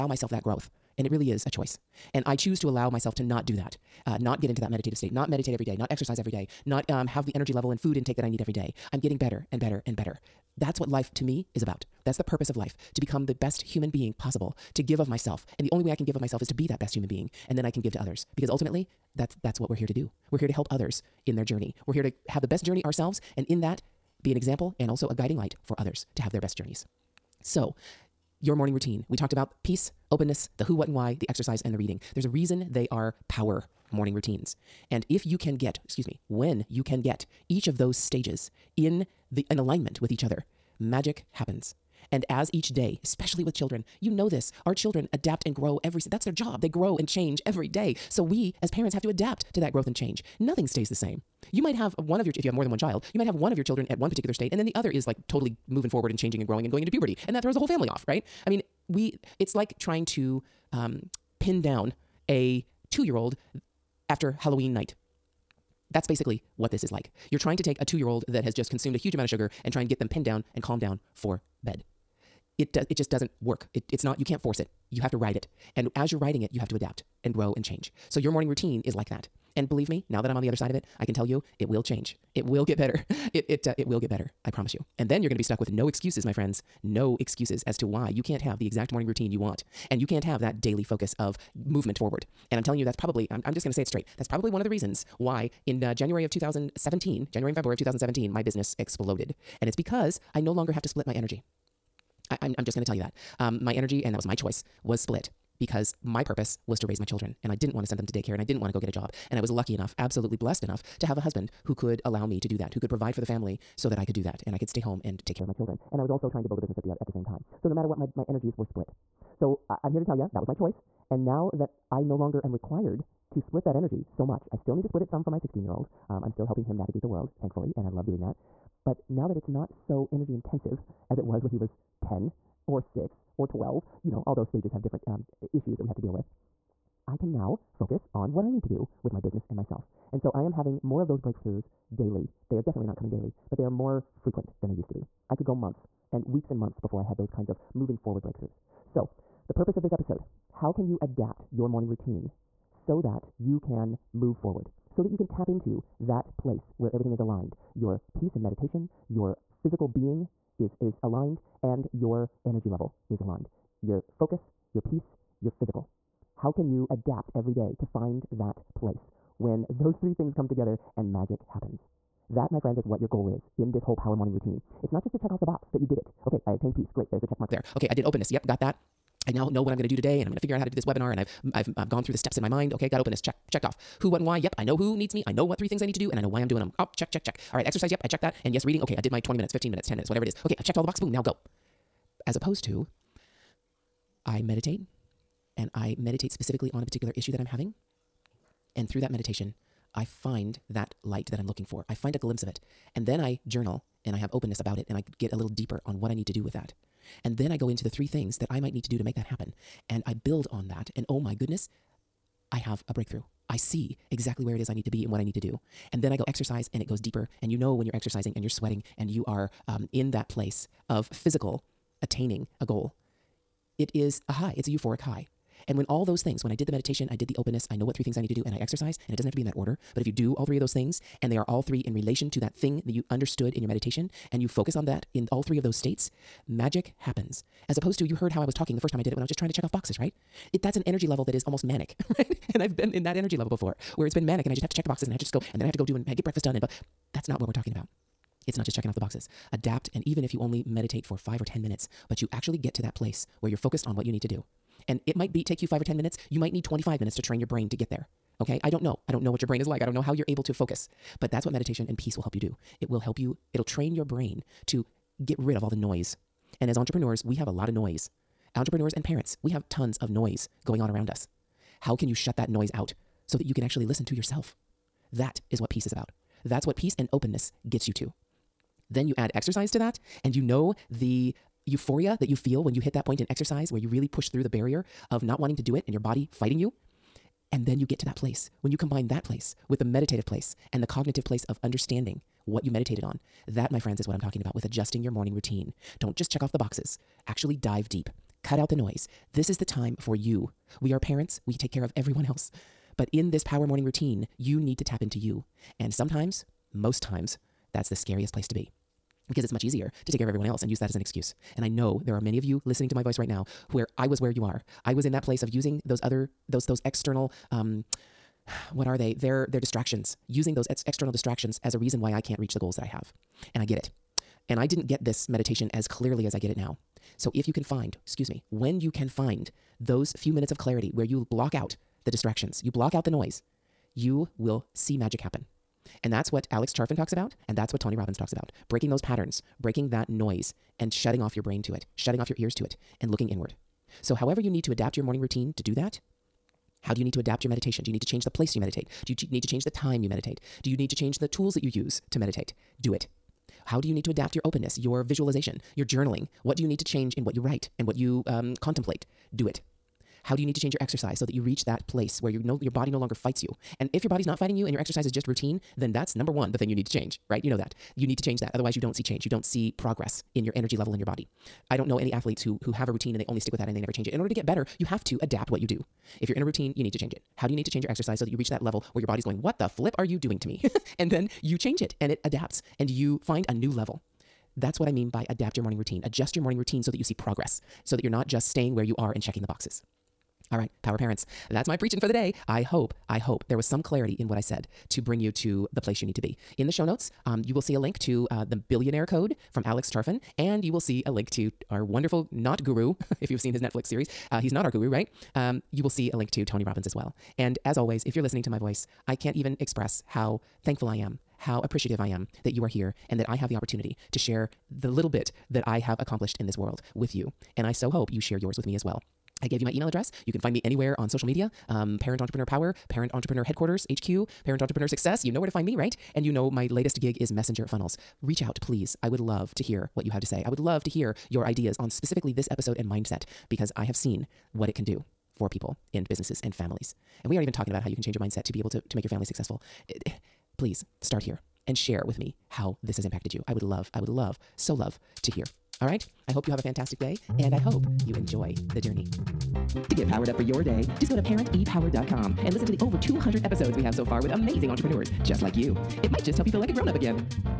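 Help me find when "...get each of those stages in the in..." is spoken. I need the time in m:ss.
0:37.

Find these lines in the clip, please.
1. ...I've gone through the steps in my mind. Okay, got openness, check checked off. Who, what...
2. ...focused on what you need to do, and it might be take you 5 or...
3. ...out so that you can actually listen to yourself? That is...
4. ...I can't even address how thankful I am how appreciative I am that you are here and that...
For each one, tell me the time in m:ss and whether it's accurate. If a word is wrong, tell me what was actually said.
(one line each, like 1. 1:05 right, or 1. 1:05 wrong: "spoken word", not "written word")
1. 3:01 right
2. 4:13 right
3. 4:32 right
4. 6:49 wrong: "express", not "address".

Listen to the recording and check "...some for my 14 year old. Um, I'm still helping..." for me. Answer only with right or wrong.
wrong.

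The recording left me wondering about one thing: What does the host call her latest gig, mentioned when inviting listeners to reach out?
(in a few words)
Messenger Funnels.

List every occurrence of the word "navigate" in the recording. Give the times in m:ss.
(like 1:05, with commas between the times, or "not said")
2:06.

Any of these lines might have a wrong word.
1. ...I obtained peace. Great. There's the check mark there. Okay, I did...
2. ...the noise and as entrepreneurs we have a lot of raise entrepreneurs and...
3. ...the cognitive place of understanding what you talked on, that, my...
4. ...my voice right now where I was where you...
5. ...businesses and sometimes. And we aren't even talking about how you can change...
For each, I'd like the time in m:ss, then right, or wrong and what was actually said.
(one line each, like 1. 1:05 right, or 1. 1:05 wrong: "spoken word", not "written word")
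1. 2:56 right
2. 4:25 wrong: "noise", not "raise"
3. 4:50 wrong: "meditated", not "talked"
4. 5:12 right
5. 7:16 wrong: "families", not "sometimes".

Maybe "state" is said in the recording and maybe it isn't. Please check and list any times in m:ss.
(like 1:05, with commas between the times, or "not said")
0:04, 0:54, 3:55.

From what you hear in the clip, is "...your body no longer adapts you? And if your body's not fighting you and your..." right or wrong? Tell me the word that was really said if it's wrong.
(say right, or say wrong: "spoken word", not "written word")
wrong: "fights", not "adapts".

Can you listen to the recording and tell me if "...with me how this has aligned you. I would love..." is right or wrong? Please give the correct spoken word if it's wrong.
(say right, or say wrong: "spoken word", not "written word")
wrong: "impacted", not "aligned".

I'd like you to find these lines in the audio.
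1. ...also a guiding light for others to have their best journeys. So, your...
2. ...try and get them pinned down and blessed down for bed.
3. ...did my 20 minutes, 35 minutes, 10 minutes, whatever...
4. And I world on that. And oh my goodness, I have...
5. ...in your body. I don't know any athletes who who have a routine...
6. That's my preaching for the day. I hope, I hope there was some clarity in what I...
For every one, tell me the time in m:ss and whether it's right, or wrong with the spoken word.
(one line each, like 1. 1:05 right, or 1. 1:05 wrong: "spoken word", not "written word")
1. 0:24 right
2. 1:09 wrong: "calmed", not "blessed"
3. 3:09 wrong: "15", not "35"
4. 3:29 wrong: "build", not "world"
5. 6:10 right
6. 6:31 right.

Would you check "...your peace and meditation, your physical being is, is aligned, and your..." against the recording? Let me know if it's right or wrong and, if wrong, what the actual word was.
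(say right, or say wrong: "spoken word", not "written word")
right.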